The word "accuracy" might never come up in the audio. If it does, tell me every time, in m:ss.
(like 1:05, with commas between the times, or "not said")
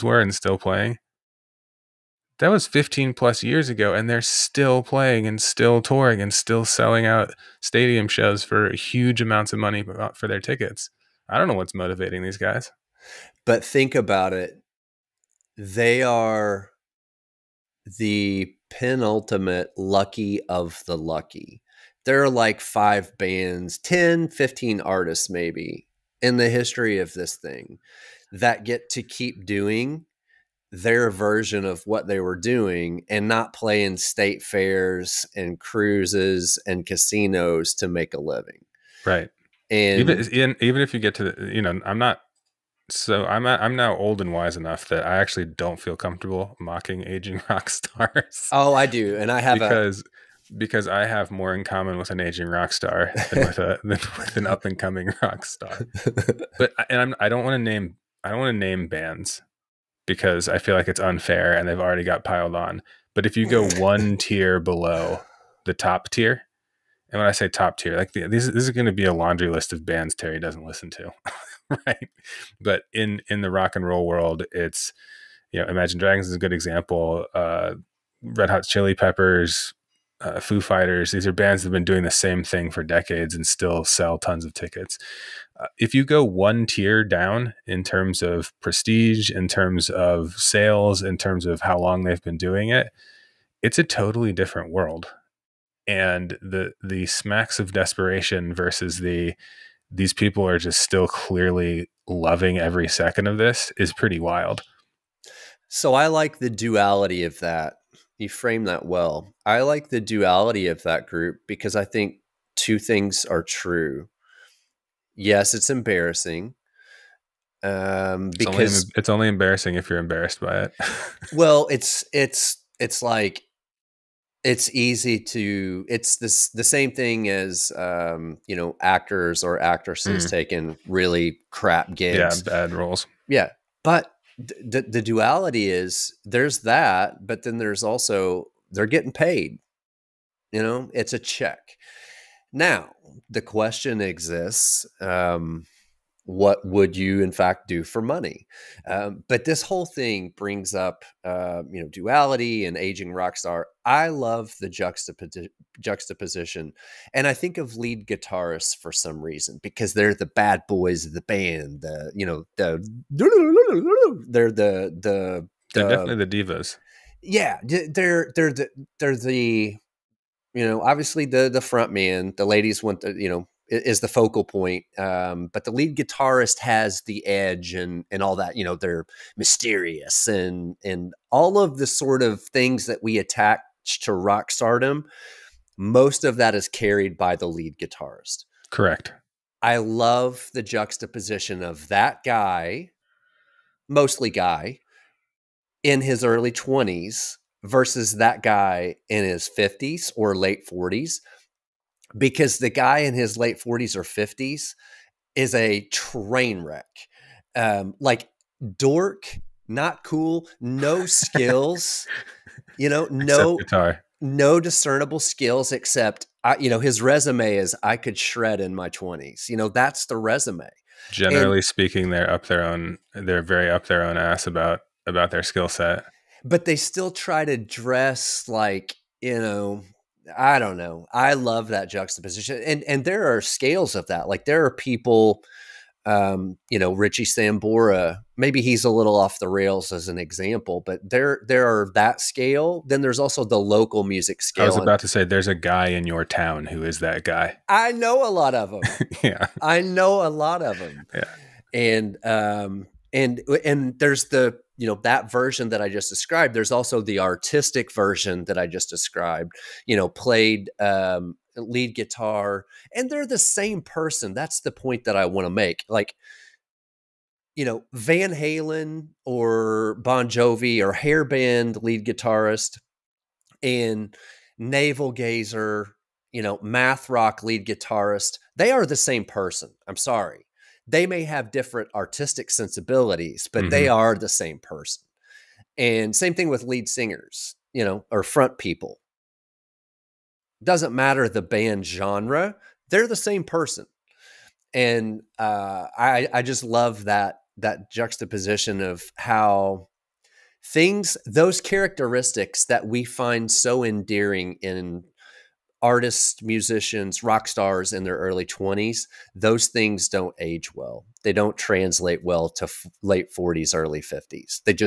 not said.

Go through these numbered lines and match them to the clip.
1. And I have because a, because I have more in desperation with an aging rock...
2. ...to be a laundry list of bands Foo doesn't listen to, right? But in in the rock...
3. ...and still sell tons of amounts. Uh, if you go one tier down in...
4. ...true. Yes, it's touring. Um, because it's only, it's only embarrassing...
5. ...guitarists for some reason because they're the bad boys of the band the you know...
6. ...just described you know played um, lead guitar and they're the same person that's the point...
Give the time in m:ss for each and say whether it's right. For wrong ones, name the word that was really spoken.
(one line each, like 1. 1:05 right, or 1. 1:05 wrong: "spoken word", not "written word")
1. 0:49 wrong: "common", not "desperation"
2. 1:08 wrong: "Terry", not "Foo"
3. 1:23 wrong: "tickets", not "amounts"
4. 1:53 wrong: "embarrassing", not "touring"
5. 2:38 right
6. 4:18 right.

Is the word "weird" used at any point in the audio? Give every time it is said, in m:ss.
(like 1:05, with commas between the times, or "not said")
not said.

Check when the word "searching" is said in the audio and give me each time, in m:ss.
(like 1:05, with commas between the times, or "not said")
not said.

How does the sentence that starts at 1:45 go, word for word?
So I like the duality of that you frame that well.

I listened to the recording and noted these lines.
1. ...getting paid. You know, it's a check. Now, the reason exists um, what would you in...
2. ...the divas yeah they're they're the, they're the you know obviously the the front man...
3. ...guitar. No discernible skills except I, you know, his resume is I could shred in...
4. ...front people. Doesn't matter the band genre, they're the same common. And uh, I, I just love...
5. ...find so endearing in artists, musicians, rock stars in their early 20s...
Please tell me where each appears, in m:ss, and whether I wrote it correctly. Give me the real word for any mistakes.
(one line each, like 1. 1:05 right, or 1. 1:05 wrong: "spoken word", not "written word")
1. 2:18 wrong: "question", not "reason"
2. 2:46 right
3. 3:33 right
4. 4:48 wrong: "person", not "common"
5. 5:03 right.